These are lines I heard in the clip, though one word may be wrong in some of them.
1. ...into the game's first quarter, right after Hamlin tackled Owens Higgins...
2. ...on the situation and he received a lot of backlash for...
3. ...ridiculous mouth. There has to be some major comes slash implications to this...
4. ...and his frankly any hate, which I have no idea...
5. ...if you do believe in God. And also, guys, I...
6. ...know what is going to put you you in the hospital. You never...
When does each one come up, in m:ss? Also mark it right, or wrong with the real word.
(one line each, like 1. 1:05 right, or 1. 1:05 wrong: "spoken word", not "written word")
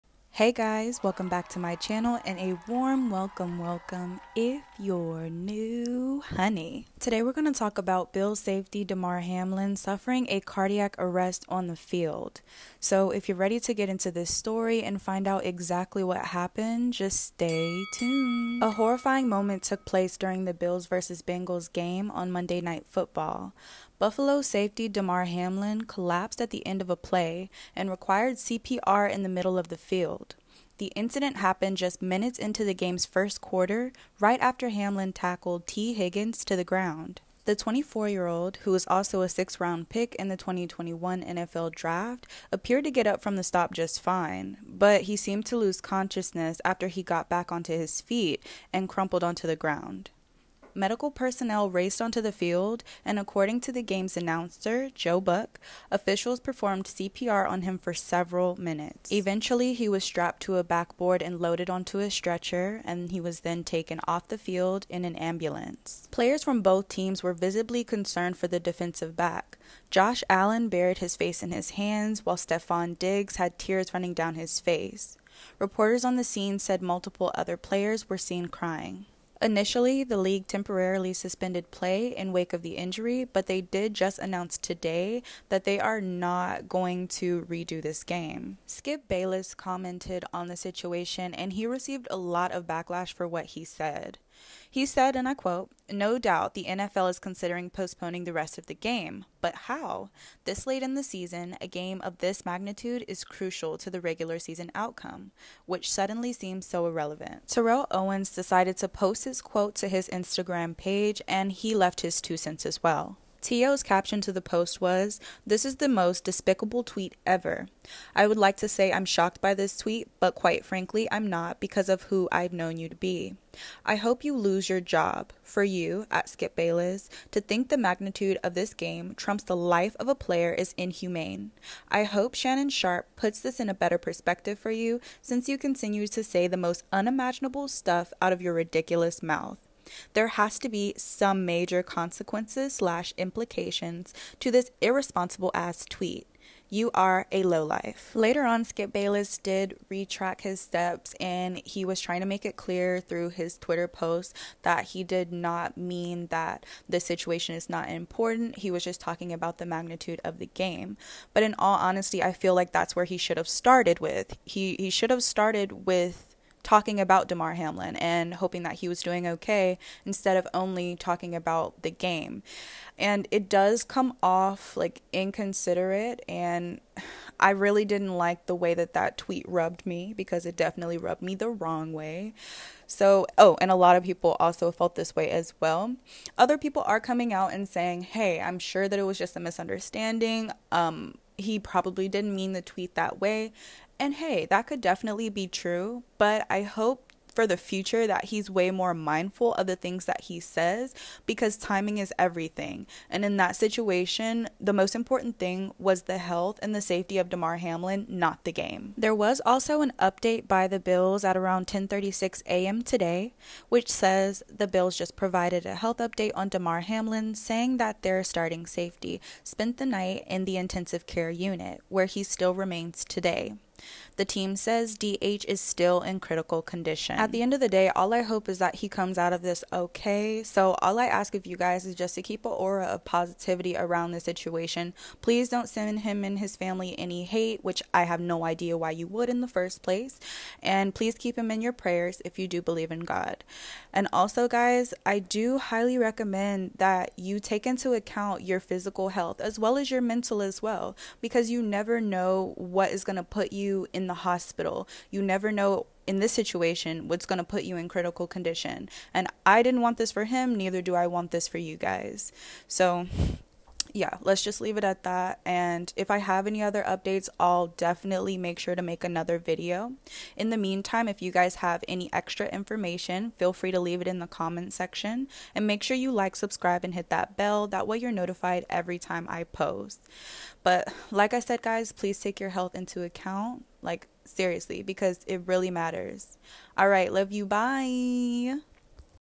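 1. 0:32 wrong: "Tee", not "Owens"
2. 1:30 right
3. 2:18 wrong: "consequences", not "comes"
4. 3:56 wrong: "family", not "frankly"
5. 4:02 right
6. 4:11 right.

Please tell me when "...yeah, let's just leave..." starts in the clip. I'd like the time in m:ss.
4:23.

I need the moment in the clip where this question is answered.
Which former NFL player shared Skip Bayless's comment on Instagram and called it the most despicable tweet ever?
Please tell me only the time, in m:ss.
1:47.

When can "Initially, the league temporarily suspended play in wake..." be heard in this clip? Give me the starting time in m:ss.
1:19.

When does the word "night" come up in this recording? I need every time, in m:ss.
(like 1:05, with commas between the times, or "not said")
0:22, 3:39.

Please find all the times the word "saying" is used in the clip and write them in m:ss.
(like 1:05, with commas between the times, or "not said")
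3:07, 3:37.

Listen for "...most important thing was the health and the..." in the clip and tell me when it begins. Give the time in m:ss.
3:24.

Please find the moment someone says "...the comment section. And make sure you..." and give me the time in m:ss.
4:34.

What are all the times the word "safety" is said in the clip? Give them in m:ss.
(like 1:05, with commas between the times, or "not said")
0:08, 0:24, 3:26, 3:38.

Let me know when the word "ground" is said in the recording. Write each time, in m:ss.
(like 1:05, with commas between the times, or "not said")
0:36, 0:49.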